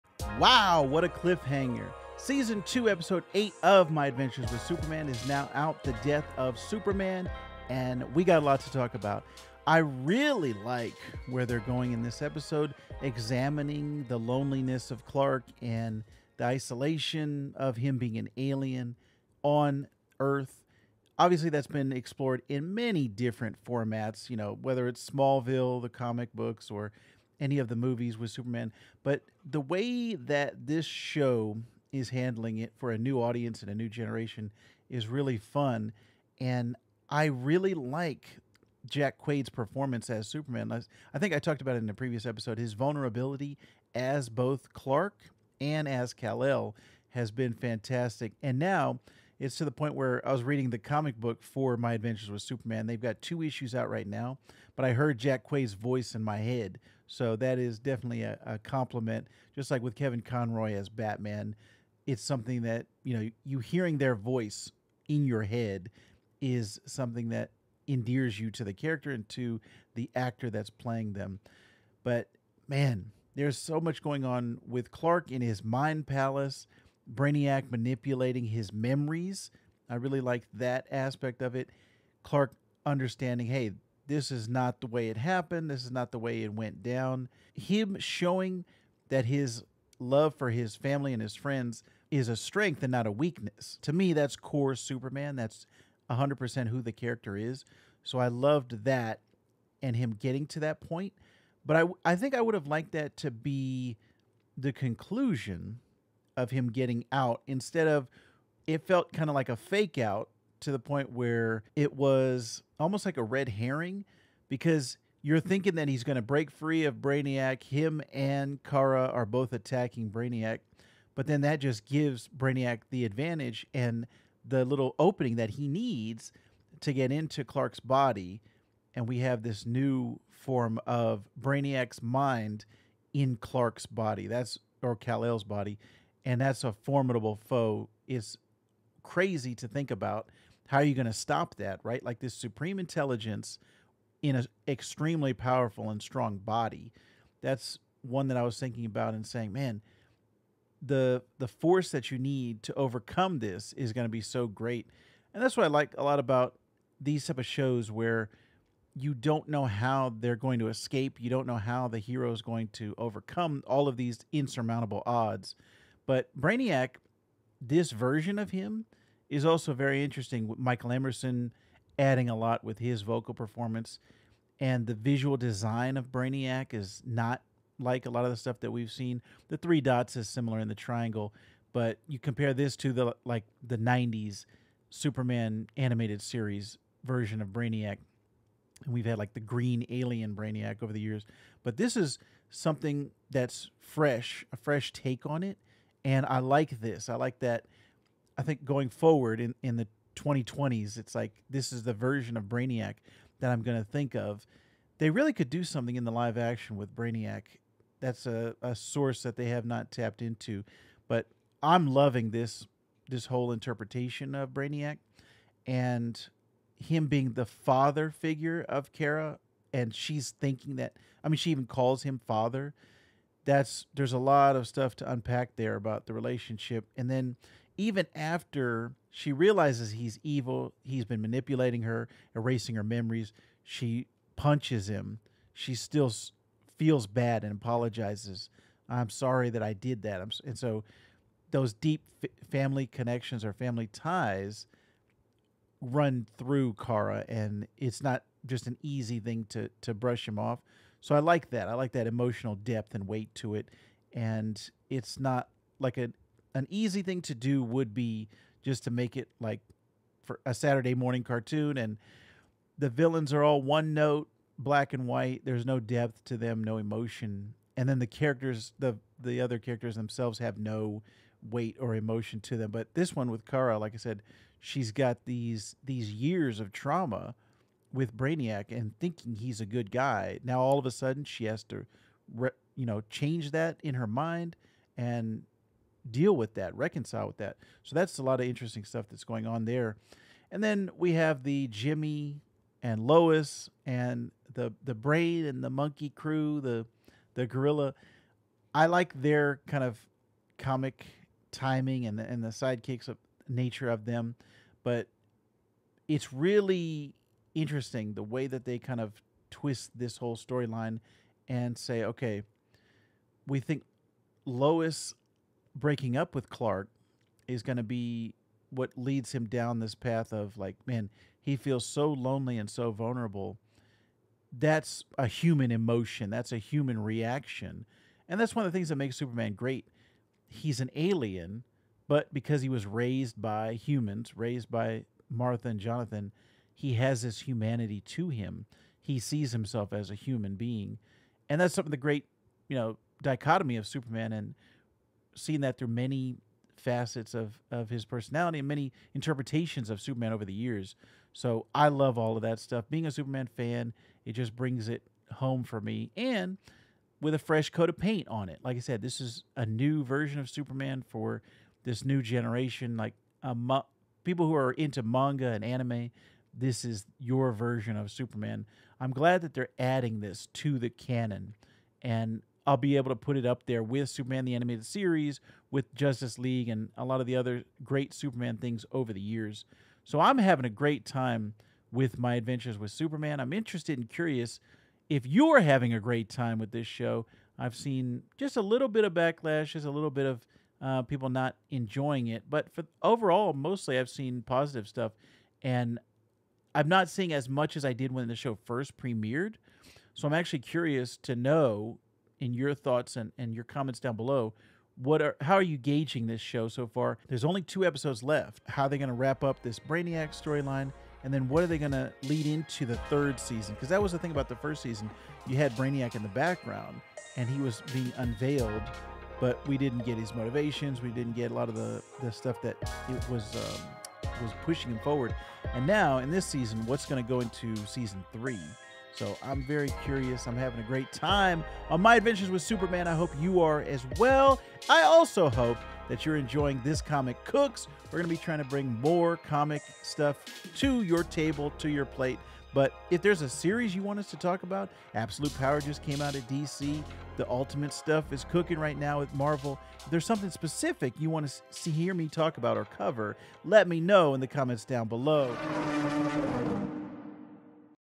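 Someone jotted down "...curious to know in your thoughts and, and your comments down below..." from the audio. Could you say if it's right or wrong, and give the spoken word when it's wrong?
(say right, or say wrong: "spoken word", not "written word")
right.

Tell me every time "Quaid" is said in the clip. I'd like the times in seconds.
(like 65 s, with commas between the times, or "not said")
39 s, 55 s.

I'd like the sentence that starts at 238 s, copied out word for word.
I'm sorry that I did that.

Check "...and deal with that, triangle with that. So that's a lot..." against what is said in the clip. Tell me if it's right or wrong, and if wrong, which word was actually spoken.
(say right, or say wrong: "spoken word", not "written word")
wrong: "reconcile", not "triangle".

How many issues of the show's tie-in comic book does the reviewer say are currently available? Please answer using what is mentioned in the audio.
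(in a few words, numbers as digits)
2.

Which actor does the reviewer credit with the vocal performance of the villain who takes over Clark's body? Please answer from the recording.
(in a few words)
Michael Emerson.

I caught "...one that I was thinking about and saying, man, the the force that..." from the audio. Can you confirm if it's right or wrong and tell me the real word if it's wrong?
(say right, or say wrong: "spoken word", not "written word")
right.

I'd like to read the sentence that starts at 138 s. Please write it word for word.
It's crazy to think about how are you going to stop that, right?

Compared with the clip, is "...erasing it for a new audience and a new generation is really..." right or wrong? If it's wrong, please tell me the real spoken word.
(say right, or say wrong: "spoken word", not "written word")
wrong: "handling", not "erasing".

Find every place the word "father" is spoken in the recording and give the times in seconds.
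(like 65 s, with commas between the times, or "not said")
217 s, 222 s.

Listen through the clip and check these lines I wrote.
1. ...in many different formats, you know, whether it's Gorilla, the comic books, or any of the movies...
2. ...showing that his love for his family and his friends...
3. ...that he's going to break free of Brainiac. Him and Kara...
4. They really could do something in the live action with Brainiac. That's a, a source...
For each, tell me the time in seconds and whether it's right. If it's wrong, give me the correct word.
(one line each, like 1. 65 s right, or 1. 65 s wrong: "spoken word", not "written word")
1. 22 s wrong: "Smallville", not "Gorilla"
2. 87 s right
3. 115 s right
4. 204 s right.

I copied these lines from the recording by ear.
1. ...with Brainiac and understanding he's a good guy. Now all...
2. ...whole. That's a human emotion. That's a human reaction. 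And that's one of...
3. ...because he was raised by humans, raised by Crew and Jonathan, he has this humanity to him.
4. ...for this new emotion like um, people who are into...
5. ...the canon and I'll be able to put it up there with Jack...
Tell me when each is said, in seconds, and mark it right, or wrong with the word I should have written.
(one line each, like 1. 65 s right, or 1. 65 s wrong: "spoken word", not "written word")
1. 277 s wrong: "thinking", not "understanding"
2. 322 s wrong: "vulnerable", not "whole"
3. 332 s wrong: "Martha", not "Crew"
4. 361 s wrong: "generation", not "emotion"
5. 370 s wrong: "Superman", not "Jack".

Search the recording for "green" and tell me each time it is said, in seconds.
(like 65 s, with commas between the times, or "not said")
189 s.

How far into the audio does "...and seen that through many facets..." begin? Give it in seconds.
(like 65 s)
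344 s.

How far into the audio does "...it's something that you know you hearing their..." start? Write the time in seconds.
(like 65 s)
62 s.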